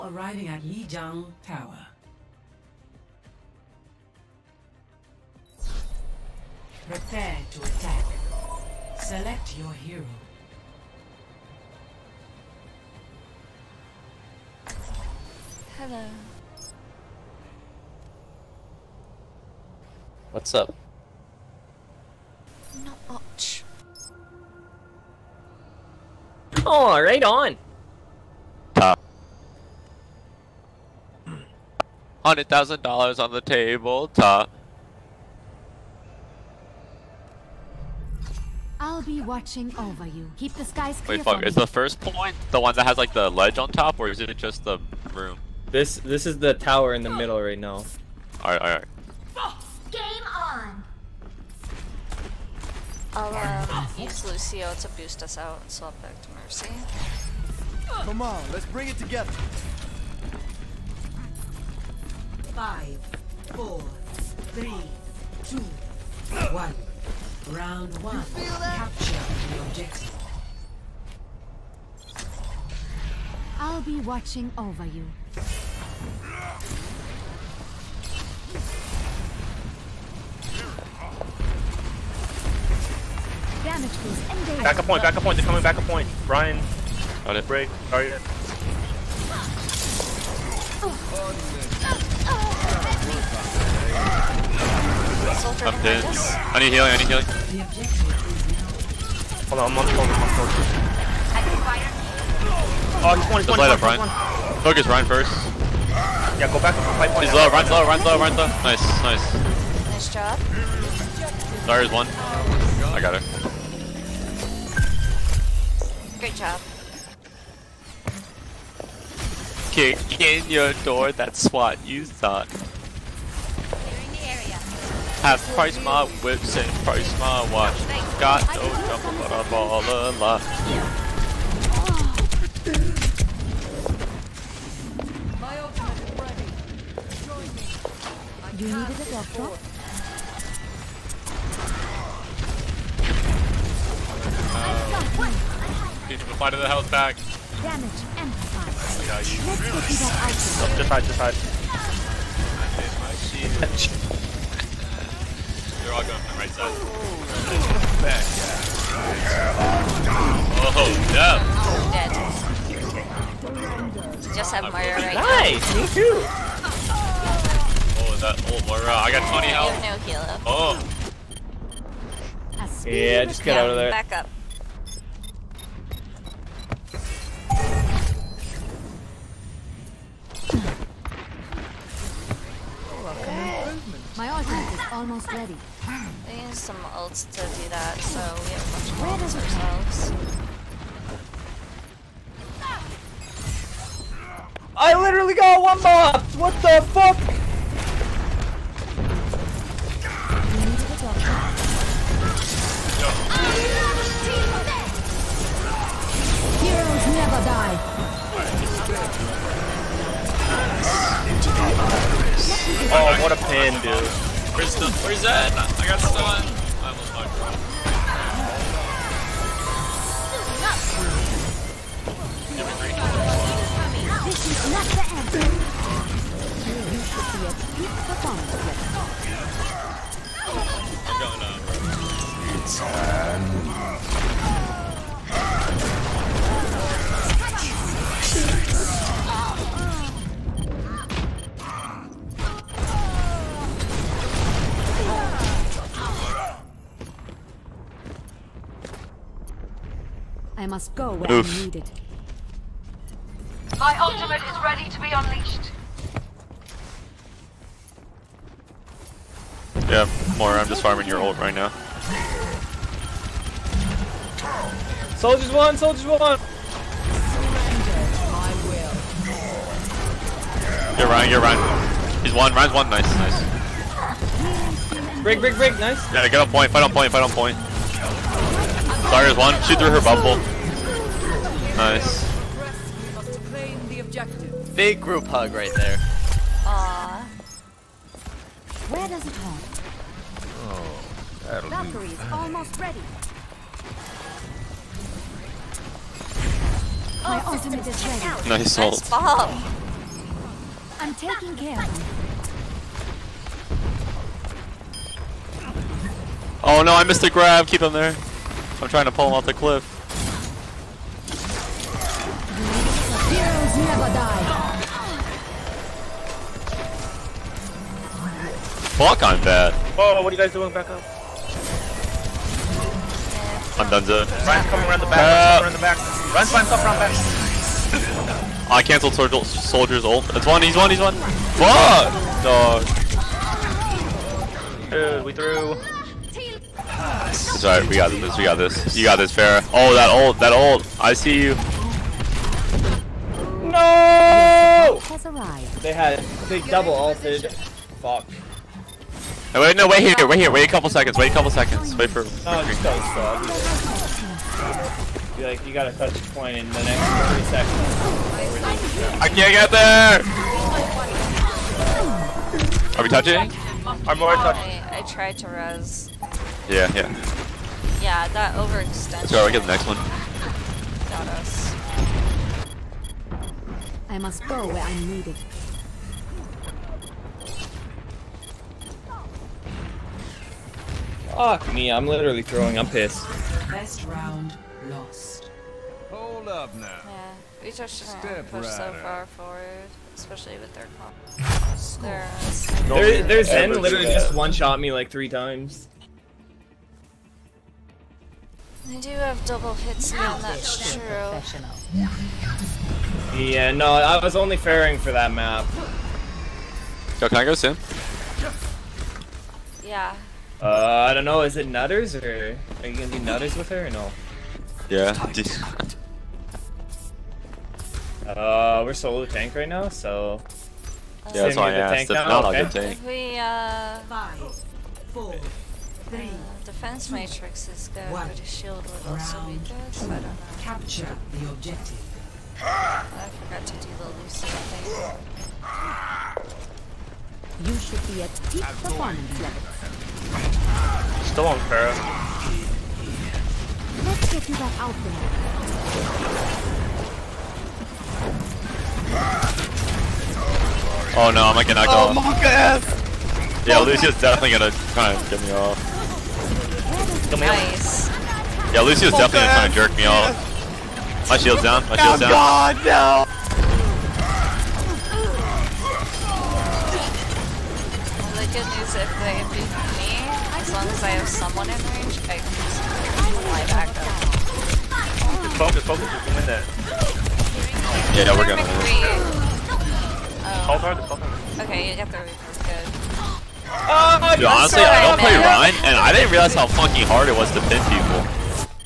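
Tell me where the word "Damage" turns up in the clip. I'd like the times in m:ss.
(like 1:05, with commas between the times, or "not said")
2:27.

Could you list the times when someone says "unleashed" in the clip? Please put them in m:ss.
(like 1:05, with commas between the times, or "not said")
4:15.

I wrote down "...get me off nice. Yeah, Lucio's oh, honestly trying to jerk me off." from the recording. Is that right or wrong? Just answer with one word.
wrong.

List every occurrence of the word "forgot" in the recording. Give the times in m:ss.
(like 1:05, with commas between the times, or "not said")
7:13.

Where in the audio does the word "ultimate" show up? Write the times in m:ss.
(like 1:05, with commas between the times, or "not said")
4:13, 4:57.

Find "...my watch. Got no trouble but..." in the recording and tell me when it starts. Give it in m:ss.
2:07.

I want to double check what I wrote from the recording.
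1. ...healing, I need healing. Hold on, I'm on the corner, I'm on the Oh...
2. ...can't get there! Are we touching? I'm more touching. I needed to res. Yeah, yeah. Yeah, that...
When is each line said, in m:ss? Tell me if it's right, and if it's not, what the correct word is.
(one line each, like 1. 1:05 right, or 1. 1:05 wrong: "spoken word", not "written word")
1. 1:36 right
2. 5:59 wrong: "tried", not "needed".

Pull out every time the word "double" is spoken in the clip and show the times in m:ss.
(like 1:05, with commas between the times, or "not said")
5:46, 6:39.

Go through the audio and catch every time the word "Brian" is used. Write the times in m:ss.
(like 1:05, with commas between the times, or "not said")
1:26.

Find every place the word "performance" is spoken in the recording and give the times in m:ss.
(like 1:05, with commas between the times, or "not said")
3:48, 7:18.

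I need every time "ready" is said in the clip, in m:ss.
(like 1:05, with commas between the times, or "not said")
3:05, 4:14, 4:52, 4:58.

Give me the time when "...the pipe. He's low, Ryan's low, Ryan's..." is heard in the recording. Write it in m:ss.
1:46.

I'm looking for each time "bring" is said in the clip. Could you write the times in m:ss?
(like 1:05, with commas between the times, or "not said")
0:58.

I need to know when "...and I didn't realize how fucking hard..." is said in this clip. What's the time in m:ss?
8:05.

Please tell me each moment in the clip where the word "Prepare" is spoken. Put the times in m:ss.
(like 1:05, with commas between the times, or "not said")
0:06.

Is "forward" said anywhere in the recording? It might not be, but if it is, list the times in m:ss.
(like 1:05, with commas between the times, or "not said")
6:29.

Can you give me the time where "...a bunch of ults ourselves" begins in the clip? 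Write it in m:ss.
3:08.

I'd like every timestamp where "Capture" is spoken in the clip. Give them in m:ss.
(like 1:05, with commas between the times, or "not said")
1:08, 7:10.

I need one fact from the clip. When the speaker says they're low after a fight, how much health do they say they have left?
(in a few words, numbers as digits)
20.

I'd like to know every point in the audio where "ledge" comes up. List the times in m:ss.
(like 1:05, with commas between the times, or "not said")
0:43.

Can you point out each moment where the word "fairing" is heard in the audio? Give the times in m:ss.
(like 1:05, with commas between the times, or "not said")
6:44.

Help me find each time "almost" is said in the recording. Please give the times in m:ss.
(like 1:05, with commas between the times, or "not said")
3:04, 3:36, 4:52.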